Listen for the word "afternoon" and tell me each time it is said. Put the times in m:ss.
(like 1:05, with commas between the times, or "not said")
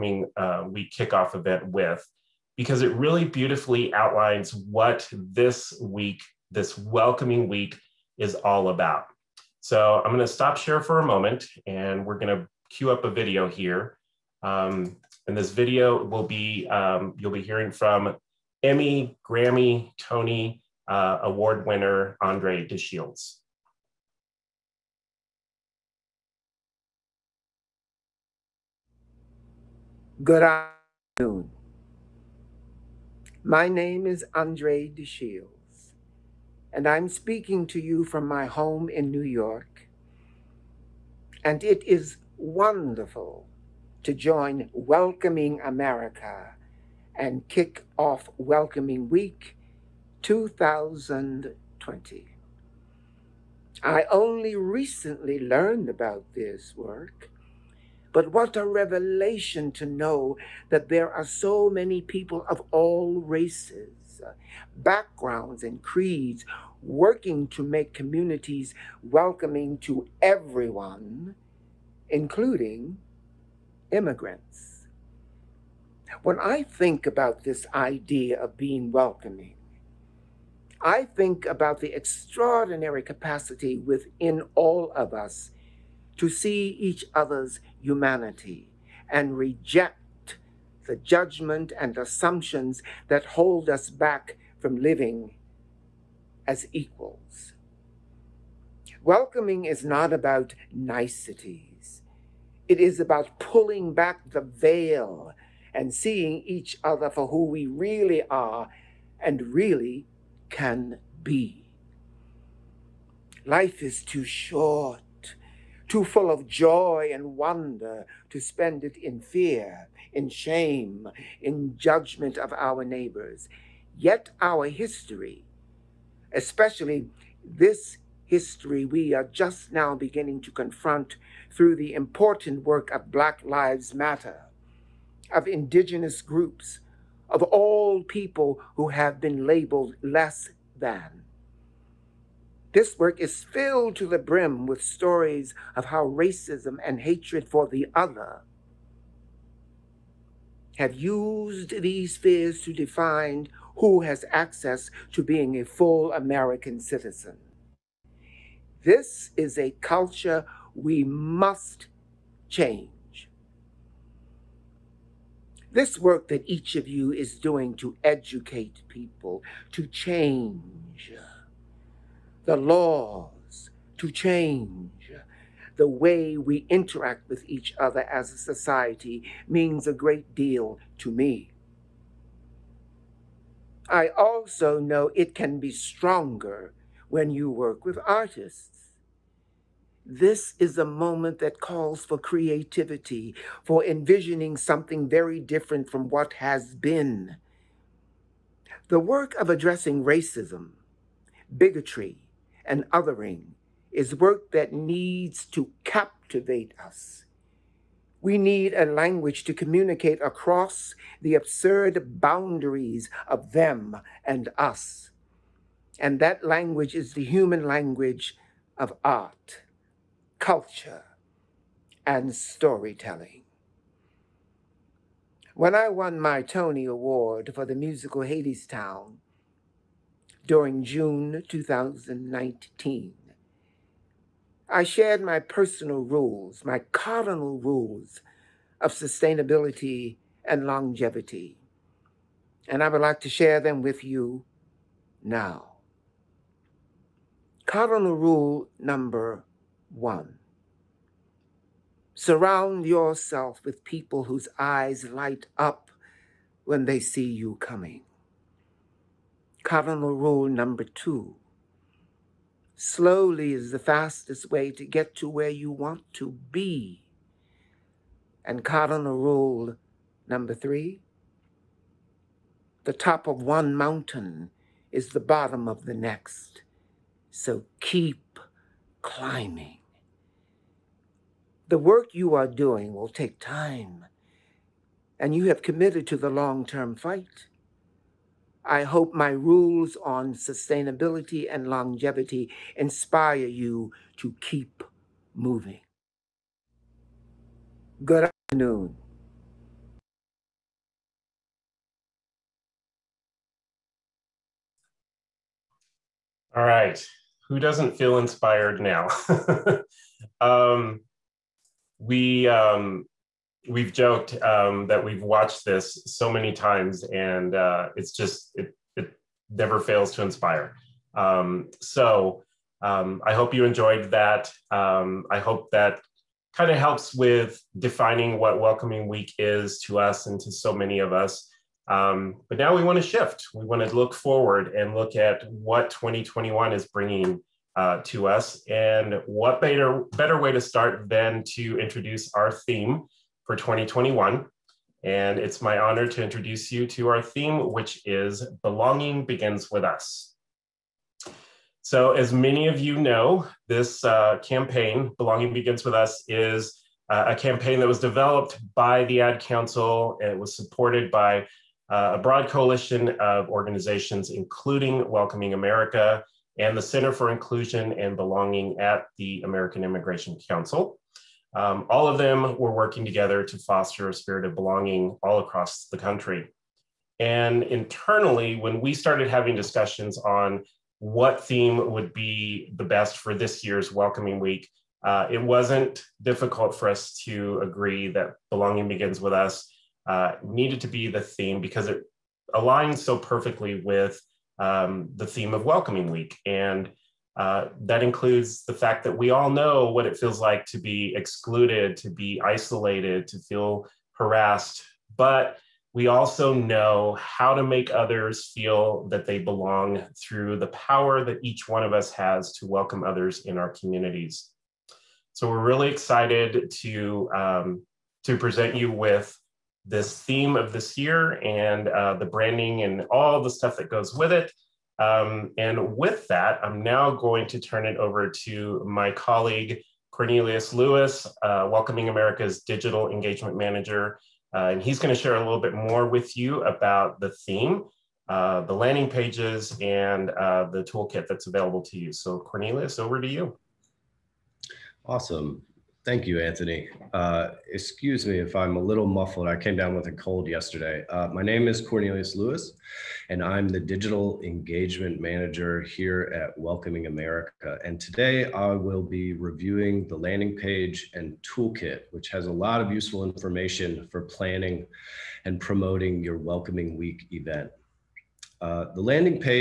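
0:30, 4:58.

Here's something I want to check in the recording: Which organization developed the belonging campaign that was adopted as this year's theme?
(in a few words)
The Ad Council.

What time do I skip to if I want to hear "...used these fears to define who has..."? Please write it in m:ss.
2:30.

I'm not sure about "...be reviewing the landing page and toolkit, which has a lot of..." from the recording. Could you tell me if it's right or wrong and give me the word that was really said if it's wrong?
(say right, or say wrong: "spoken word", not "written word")
right.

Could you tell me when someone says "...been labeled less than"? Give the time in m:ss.
2:19.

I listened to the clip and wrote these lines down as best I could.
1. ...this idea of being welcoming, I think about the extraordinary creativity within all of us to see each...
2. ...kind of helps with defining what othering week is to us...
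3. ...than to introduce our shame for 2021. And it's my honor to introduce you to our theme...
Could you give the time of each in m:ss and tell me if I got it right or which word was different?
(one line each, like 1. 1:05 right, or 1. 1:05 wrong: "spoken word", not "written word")
1. 1:17 wrong: "capacity", not "creativity"
2. 5:26 wrong: "welcoming", not "othering"
3. 5:41 wrong: "theme", not "shame".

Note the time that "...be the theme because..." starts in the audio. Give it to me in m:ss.
6:30.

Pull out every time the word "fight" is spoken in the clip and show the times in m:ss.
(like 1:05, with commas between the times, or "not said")
4:46.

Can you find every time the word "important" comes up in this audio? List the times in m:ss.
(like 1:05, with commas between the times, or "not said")
2:11.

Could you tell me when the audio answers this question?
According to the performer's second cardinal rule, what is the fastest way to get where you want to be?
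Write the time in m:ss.
4:22.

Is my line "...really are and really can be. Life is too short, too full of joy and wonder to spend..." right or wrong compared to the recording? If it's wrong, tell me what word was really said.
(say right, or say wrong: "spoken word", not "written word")
right.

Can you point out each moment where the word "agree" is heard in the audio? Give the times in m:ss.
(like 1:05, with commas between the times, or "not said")
6:27.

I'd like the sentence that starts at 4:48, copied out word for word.
I hope my rules on sustainability and longevity inspire you to keep moving.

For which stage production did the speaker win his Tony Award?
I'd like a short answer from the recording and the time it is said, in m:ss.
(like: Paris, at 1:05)
Hadestown, at 3:48.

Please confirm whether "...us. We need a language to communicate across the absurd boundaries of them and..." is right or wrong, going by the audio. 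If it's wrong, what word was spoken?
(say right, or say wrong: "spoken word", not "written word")
right.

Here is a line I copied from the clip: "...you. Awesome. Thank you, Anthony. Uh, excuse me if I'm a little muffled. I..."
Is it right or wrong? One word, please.
right.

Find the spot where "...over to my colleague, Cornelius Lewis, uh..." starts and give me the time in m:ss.
7:07.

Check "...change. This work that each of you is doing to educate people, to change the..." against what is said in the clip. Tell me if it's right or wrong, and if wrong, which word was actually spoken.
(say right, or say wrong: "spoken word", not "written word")
right.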